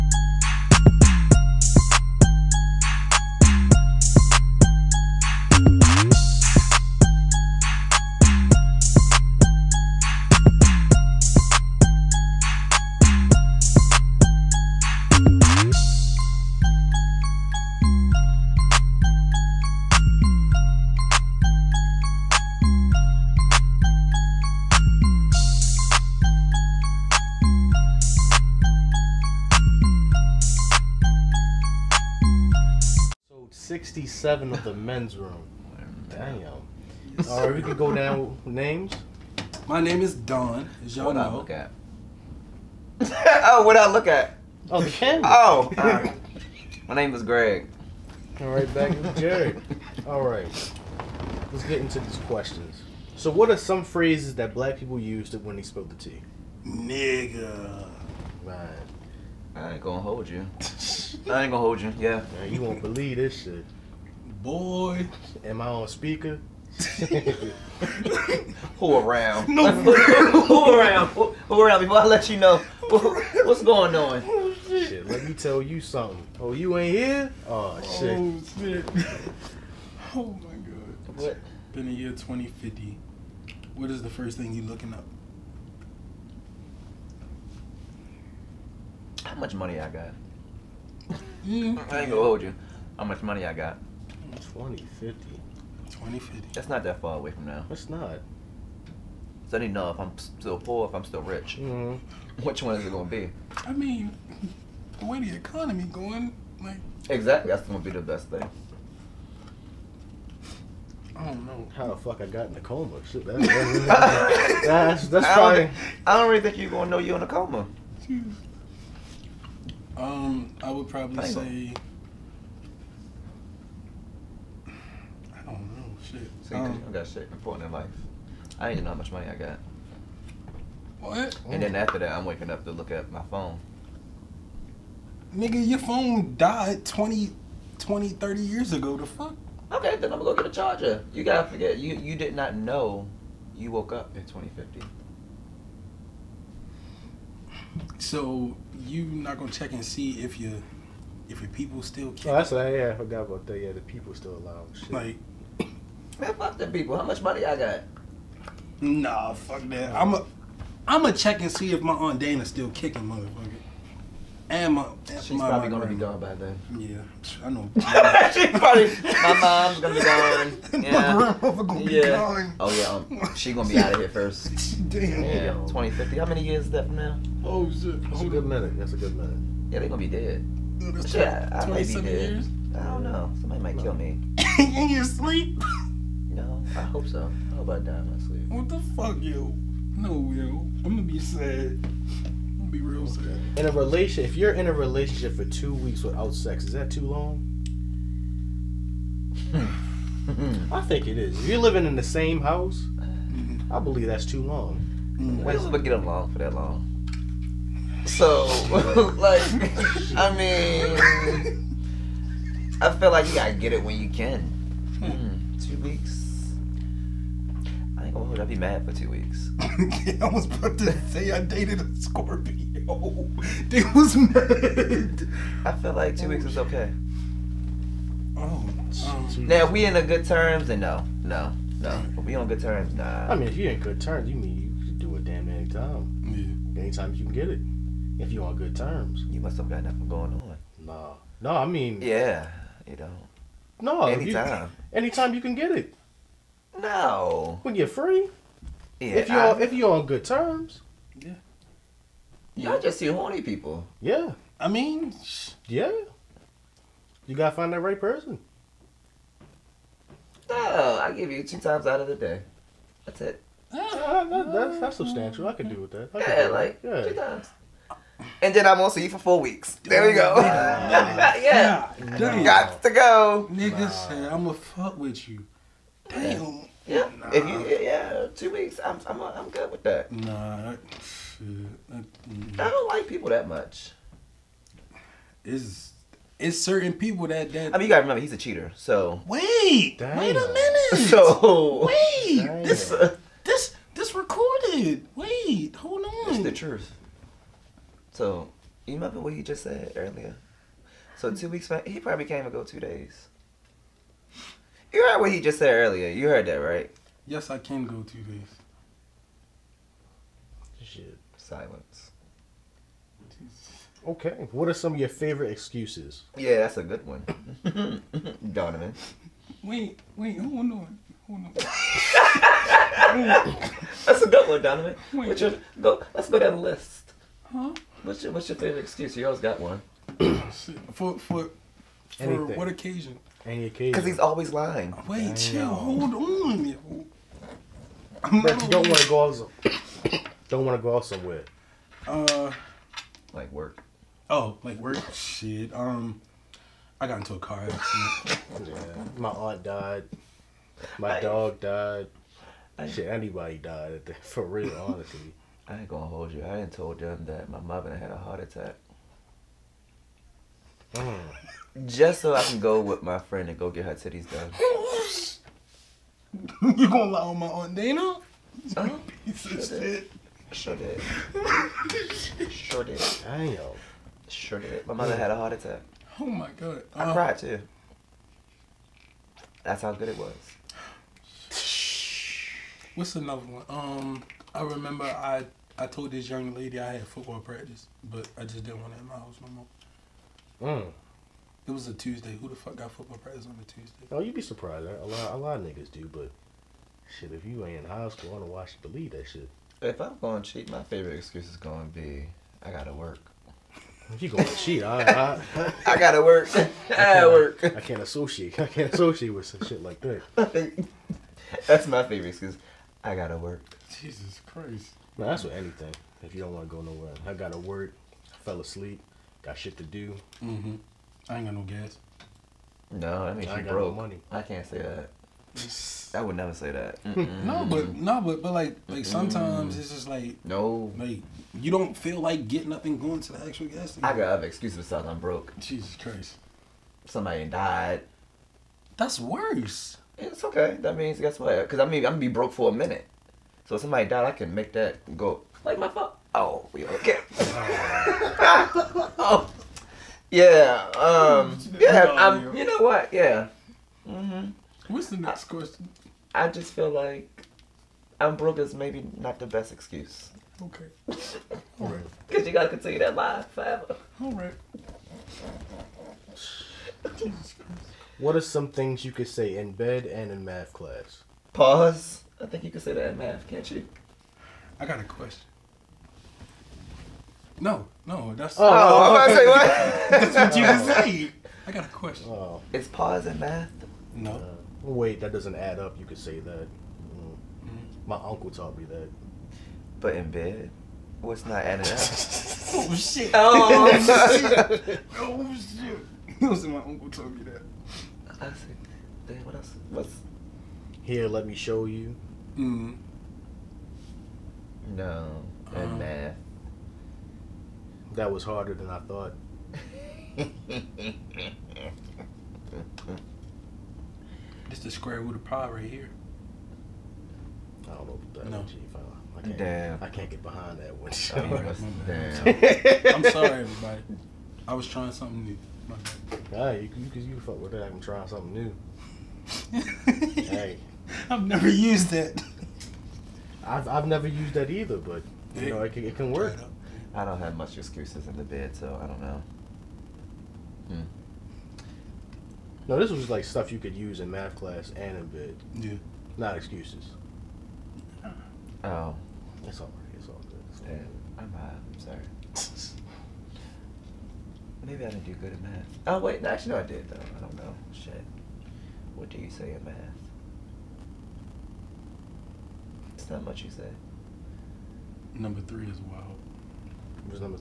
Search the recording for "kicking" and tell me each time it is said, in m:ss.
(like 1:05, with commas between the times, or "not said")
2:32, 2:42.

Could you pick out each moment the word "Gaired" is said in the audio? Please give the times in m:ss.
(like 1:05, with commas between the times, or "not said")
0:49.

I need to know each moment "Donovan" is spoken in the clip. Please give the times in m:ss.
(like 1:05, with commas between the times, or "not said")
5:18, 5:24.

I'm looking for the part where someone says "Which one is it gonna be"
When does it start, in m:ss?
1:42.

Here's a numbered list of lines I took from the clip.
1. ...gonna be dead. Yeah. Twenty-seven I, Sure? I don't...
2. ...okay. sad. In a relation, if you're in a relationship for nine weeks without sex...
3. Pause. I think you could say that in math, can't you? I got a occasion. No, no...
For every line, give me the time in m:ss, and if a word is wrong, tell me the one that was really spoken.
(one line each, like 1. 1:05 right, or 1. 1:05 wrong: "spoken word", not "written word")
1. 2:59 wrong: "Years", not "Sure"
2. 3:13 wrong: "two", not "nine"
3. 7:51 wrong: "question", not "occasion".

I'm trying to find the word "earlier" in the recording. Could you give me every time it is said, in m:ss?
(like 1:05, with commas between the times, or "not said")
4:59, 5:05.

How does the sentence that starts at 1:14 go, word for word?
Oh, shit, let me tell you something.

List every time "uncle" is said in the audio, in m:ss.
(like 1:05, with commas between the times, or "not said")
8:08, 8:16.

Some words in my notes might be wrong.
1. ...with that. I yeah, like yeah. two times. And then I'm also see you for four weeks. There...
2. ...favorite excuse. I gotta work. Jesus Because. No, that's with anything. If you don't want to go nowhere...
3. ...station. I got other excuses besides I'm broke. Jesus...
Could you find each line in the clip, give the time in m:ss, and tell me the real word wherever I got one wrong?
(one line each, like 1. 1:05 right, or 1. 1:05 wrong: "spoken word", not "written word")
1. 4:25 right
2. 6:52 wrong: "Christ", not "Because"
3. 7:13 right.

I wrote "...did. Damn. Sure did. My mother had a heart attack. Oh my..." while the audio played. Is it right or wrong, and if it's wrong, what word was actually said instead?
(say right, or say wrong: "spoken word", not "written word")
right.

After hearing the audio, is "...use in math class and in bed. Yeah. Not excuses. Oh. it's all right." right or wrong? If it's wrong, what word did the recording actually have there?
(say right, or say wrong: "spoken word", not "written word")
right.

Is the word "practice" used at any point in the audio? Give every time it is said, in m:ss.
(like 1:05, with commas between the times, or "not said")
6:27, 6:33.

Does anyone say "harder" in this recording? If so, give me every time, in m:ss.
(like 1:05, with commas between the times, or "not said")
8:28.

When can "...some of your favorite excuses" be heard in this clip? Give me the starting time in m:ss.
5:14.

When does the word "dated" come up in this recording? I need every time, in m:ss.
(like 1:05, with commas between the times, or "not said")
3:41.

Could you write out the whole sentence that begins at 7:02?
No, that means I you broke.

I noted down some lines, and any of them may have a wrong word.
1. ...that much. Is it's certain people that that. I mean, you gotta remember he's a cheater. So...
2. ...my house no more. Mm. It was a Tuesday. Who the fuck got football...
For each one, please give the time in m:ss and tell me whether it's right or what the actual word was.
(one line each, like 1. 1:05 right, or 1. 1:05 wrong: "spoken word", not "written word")
1. 4:43 right
2. 6:29 right.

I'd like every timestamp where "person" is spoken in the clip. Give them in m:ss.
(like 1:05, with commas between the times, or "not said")
4:17.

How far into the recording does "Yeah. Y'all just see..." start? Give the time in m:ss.
4:11.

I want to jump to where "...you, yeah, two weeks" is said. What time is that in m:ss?
4:37.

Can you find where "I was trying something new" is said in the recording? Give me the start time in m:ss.
8:44.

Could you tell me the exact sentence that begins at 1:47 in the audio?
Exactly, that's gonna be the best thing.